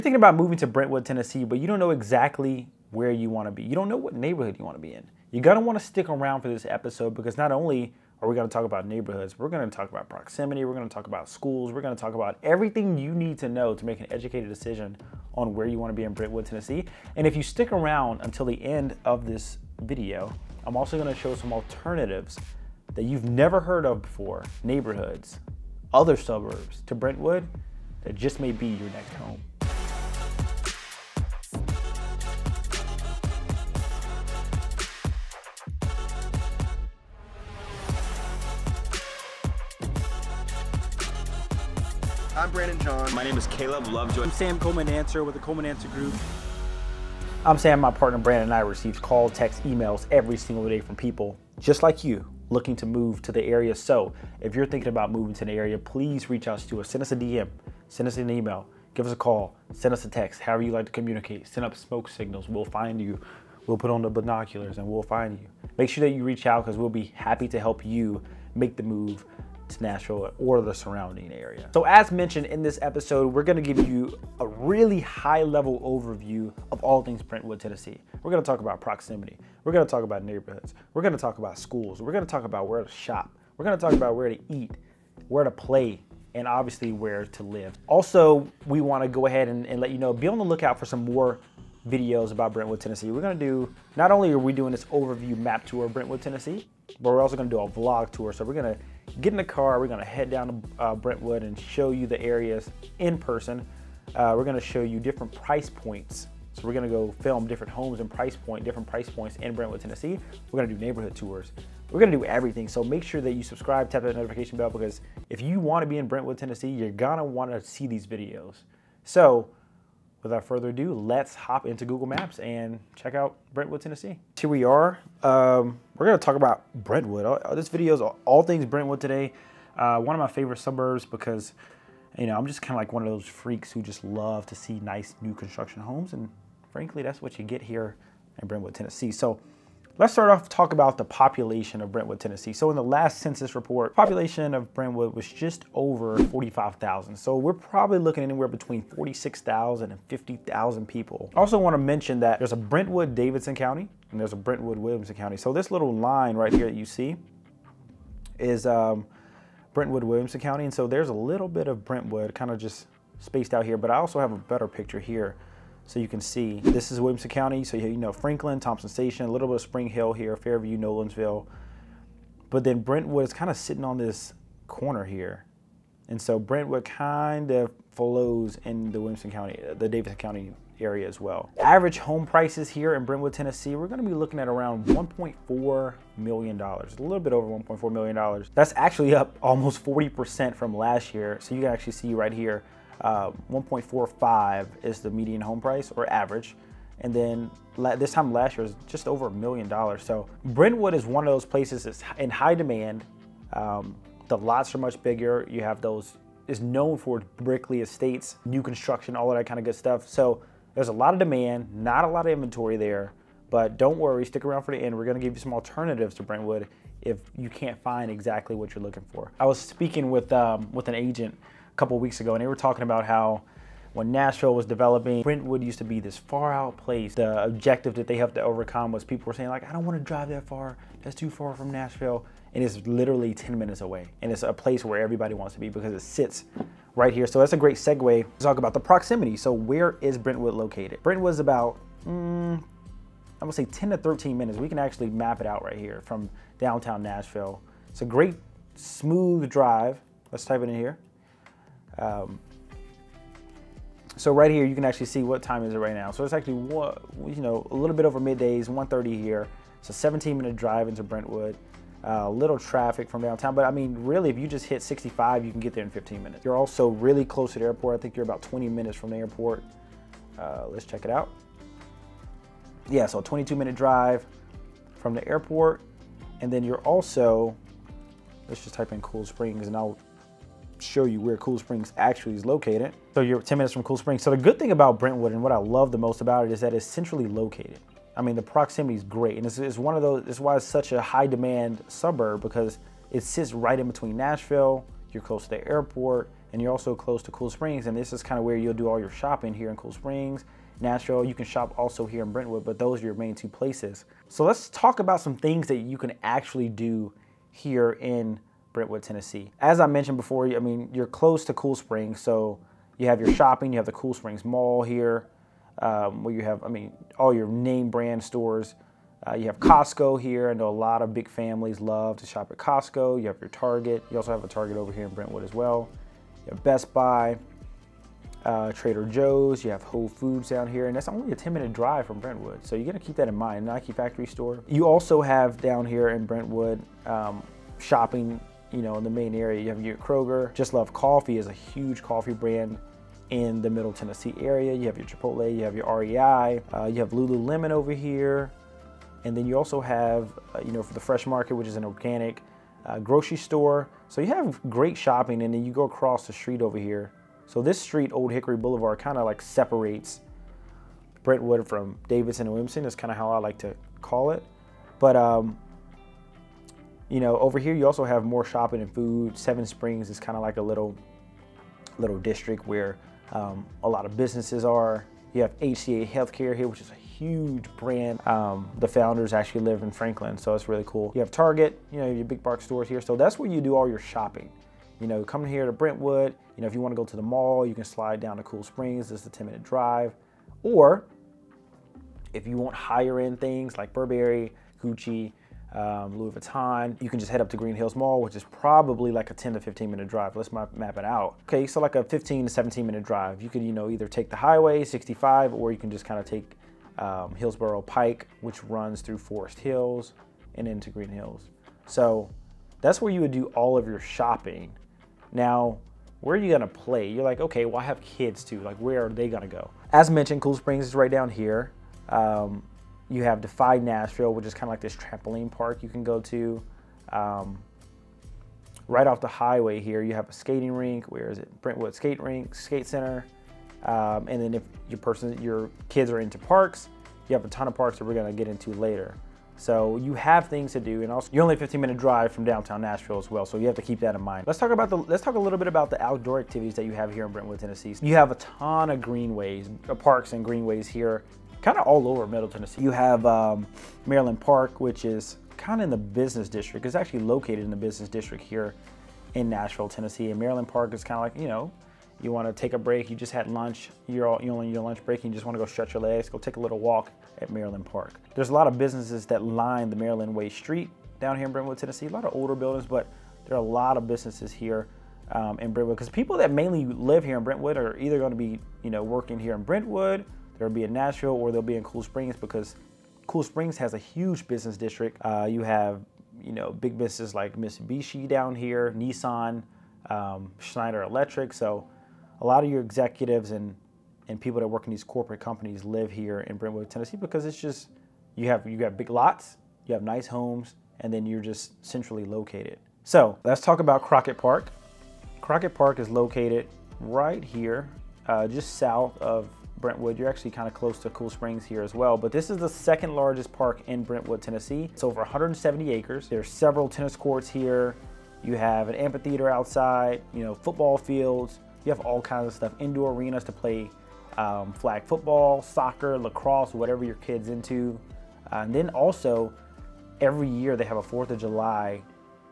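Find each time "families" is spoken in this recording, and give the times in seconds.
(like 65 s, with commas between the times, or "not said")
321 s.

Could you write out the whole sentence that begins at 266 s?
You're also really close to the airport.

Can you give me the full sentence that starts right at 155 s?
So this little line right here that you see is um, Brentwood Williamson County.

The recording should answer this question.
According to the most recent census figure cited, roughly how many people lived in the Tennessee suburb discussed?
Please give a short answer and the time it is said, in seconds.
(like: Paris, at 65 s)
just over 45,000, at 145 s.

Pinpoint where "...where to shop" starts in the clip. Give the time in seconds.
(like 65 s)
82 s.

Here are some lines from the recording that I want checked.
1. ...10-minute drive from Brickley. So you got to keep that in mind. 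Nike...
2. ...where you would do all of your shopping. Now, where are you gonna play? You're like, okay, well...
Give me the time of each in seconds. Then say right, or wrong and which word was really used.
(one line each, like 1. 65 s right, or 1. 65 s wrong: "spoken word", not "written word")
1. 331 s wrong: "Brentwood", not "Brickley"
2. 413 s right.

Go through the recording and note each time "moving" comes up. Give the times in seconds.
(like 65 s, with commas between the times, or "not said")
0 s, 55 s.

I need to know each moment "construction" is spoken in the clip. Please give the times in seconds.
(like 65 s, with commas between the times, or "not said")
135 s, 208 s.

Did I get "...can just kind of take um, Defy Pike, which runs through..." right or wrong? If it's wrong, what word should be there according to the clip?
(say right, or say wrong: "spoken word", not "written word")
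wrong: "Hillsboro", not "Defy".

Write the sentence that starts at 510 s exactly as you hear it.
You're actually kind of close to Cool Springs here as well, but this is the second largest park in Brentwood, Tennessee.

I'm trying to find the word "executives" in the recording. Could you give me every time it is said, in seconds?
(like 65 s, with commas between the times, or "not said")
492 s.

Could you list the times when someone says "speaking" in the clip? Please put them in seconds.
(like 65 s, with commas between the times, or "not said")
219 s.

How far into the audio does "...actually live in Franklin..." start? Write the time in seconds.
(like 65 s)
379 s.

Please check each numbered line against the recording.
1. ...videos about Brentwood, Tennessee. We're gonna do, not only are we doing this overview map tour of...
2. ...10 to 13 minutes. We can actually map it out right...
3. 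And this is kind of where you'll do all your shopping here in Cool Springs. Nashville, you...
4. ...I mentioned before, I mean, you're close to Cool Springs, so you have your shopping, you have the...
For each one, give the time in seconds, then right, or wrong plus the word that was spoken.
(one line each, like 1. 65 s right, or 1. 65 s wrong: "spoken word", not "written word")
1. 91 s right
2. 243 s right
3. 297 s right
4. 309 s right.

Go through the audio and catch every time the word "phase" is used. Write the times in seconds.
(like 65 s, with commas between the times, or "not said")
not said.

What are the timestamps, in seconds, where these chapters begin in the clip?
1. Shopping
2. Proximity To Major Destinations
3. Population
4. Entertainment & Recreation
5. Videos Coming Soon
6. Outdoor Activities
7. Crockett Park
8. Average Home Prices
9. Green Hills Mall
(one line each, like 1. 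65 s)
1. 303 s
2. 237 s
3. 138 s
4. 414 s
5. 84 s
6. 442 s
7. 502 s
8. 179 s
9. 389 s.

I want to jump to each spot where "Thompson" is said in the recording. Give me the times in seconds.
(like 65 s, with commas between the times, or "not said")
168 s.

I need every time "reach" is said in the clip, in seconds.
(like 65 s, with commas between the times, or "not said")
56 s, 66 s.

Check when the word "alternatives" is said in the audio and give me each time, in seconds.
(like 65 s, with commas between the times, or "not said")
21 s, 215 s.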